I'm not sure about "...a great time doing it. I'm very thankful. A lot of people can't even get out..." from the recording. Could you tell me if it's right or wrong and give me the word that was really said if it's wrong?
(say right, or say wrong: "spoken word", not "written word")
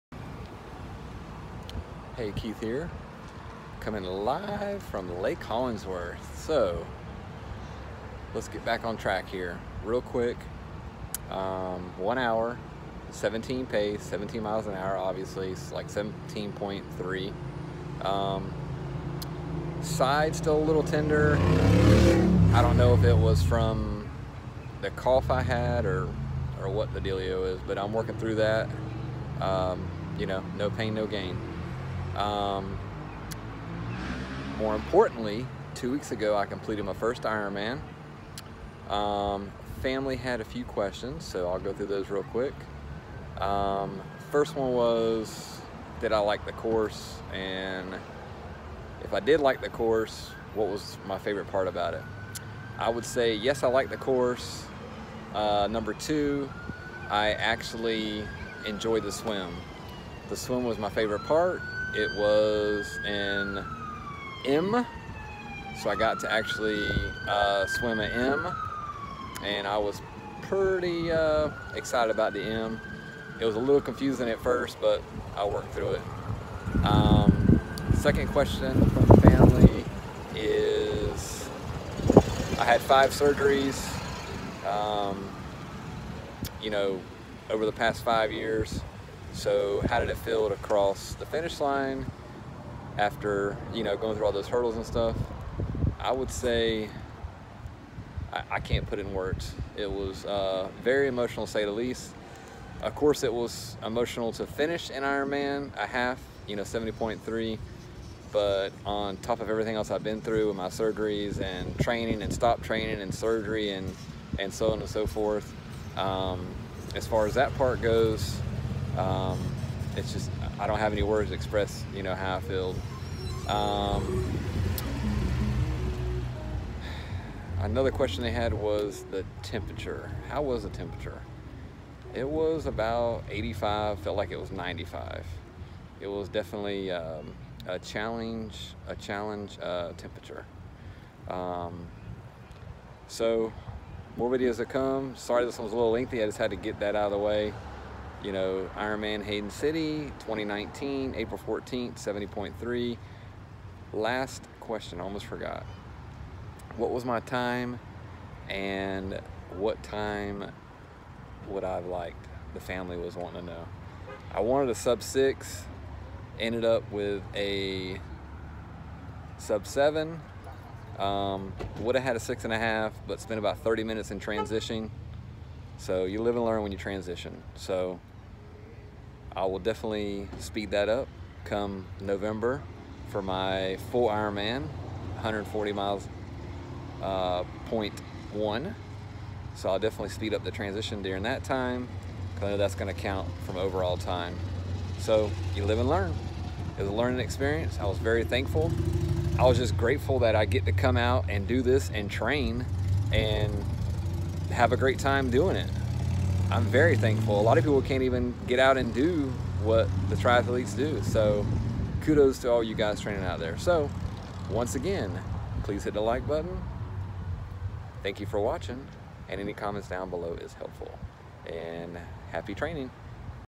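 right.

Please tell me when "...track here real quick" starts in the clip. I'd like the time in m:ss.
0:08.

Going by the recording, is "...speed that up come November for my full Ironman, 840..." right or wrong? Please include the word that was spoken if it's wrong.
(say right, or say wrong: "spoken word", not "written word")
wrong: "140", not "840".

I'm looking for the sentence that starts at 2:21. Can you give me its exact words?
Um, so more videos to come.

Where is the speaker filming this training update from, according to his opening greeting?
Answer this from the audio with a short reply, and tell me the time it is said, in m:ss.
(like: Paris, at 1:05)
Lake Hollingsworth, at 0:05.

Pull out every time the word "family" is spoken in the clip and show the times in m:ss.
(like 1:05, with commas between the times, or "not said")
0:39, 1:19, 2:42.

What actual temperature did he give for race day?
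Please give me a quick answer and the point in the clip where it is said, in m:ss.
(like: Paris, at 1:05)
85, at 2:12.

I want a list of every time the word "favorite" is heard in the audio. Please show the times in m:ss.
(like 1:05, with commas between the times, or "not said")
0:51, 1:00.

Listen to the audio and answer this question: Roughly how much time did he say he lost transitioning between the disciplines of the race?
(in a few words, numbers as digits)
30 minutes.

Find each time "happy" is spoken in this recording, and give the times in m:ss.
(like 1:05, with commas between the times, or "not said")
3:42.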